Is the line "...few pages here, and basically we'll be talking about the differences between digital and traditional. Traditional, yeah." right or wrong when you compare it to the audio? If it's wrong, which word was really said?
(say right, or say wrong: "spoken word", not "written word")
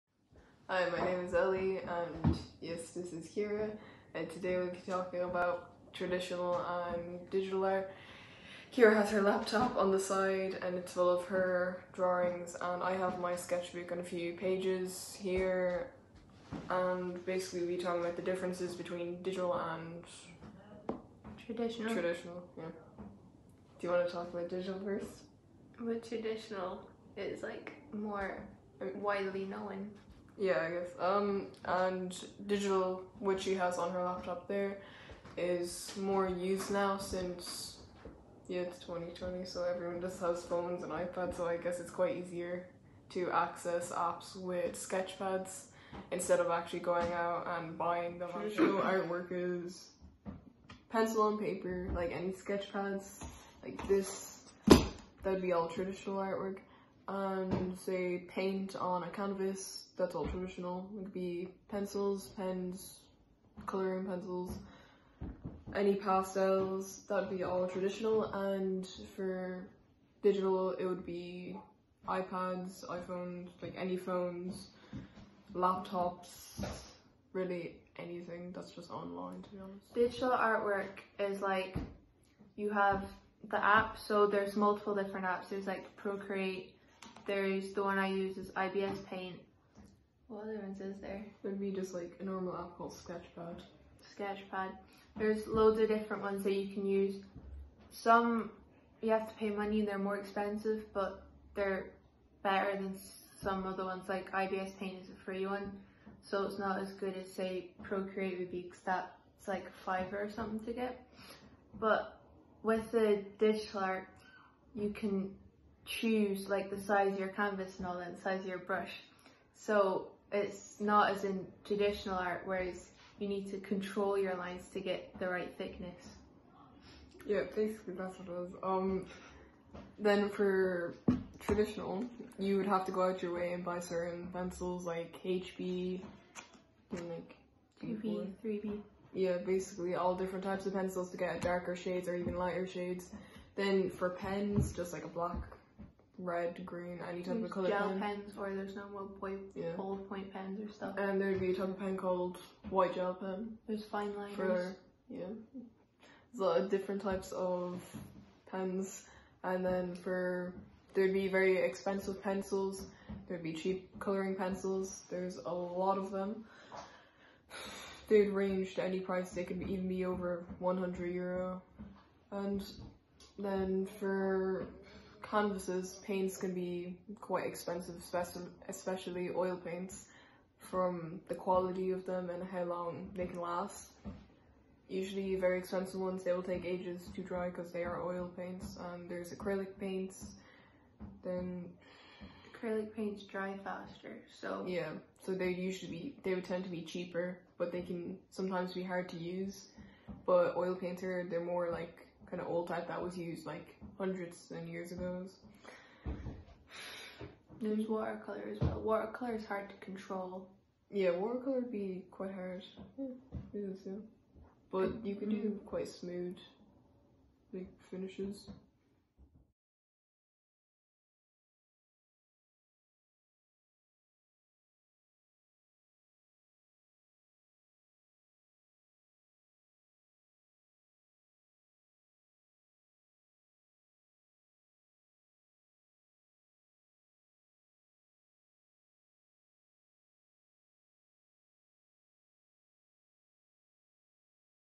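right.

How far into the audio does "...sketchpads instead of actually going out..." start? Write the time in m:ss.
0:44.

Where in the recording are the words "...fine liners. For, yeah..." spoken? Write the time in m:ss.
2:33.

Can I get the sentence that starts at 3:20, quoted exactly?
But oil paints are, they're more like kind of old type that was used like hundreds and years ago.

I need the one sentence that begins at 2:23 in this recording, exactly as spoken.
Then for pens, just like a black red, green, any type of color gel pen.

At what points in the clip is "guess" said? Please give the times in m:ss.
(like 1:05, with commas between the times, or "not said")
0:30, 0:41.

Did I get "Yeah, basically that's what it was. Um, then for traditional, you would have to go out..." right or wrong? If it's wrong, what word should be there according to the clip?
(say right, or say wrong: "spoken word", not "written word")
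right.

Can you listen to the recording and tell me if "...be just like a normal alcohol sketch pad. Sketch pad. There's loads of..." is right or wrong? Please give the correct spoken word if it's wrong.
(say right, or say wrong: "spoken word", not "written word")
right.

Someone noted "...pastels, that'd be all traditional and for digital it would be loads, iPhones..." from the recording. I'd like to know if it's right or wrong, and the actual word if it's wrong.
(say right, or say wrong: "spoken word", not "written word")
wrong: "iPads", not "loads".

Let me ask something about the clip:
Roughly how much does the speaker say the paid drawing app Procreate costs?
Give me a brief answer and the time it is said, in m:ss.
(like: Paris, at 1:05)
a fiver, at 1:49.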